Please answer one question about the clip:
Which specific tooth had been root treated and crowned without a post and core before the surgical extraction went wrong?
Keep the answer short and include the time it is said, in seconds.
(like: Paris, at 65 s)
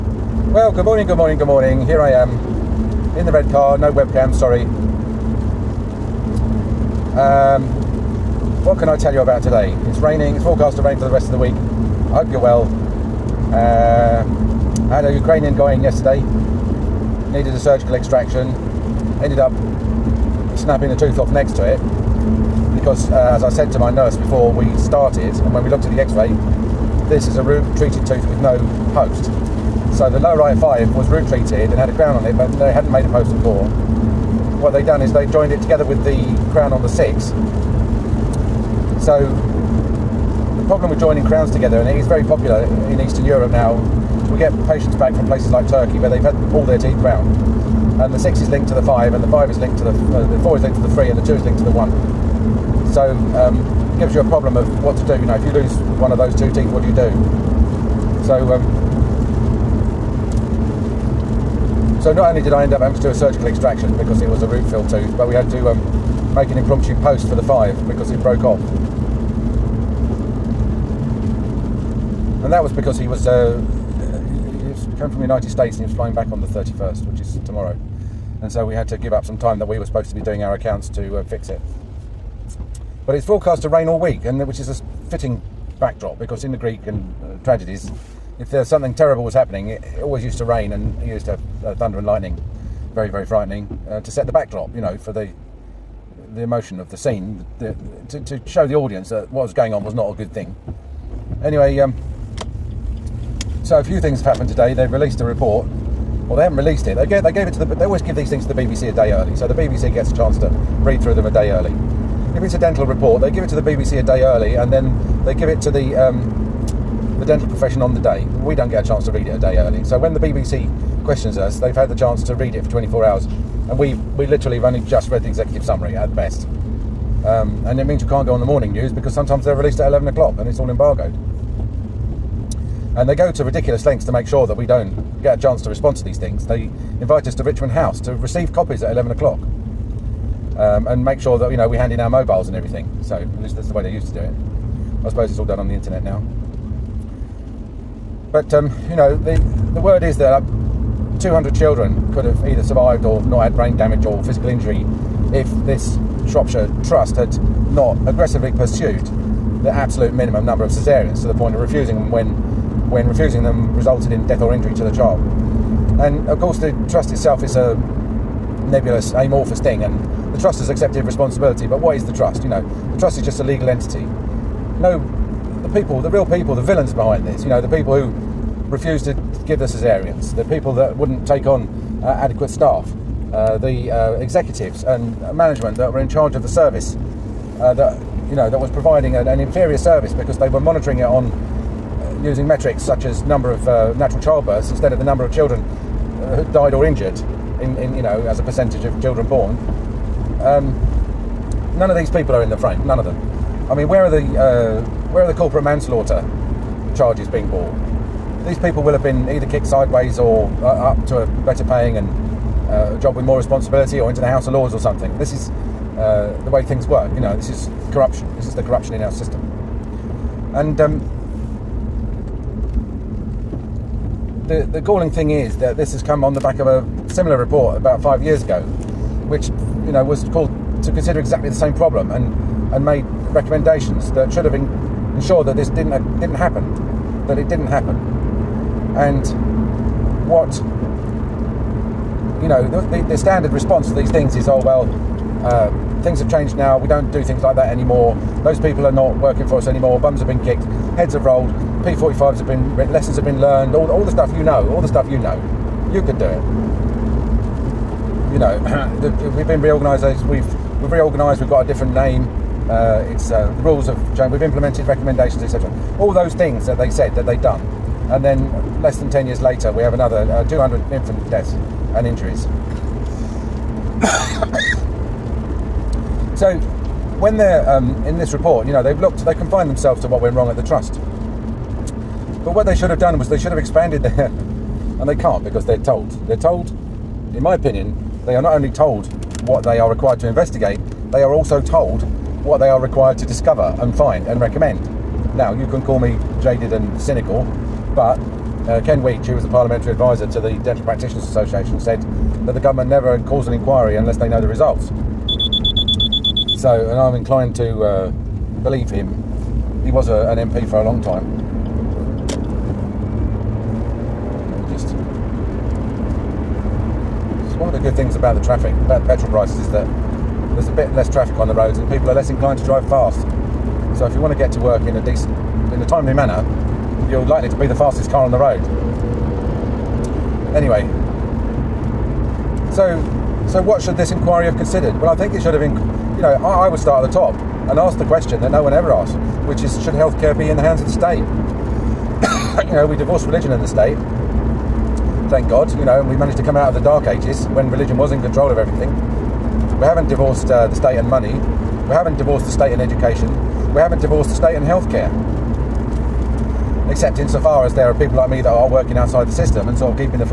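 lower right five, at 30 s.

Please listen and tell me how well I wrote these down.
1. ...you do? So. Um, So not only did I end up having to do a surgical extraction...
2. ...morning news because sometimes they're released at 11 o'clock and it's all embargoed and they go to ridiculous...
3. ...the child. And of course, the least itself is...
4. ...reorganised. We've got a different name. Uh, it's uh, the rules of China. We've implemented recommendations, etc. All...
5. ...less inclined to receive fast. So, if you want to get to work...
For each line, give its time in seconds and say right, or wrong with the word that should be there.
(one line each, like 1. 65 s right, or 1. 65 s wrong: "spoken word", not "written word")
1. 56 s right
2. 128 s right
3. 164 s wrong: "trust", not "least"
4. 260 s right
5. 322 s wrong: "drive", not "receive".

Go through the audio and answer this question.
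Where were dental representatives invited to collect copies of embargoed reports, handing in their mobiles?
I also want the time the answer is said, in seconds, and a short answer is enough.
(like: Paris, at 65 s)
Richmond House, at 137 s.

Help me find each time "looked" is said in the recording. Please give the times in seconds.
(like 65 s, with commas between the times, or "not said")
25 s, 278 s.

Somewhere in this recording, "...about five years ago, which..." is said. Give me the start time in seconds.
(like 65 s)
227 s.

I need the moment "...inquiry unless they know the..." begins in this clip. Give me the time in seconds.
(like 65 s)
303 s.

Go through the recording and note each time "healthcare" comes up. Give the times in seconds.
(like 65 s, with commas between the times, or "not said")
339 s, 354 s.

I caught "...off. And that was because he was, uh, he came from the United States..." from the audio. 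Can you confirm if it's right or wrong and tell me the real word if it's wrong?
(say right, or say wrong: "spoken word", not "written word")
right.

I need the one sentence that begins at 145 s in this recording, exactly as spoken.
I suppose it's all done on the internet now.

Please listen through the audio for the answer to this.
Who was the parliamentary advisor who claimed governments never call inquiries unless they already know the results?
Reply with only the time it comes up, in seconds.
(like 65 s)
298 s.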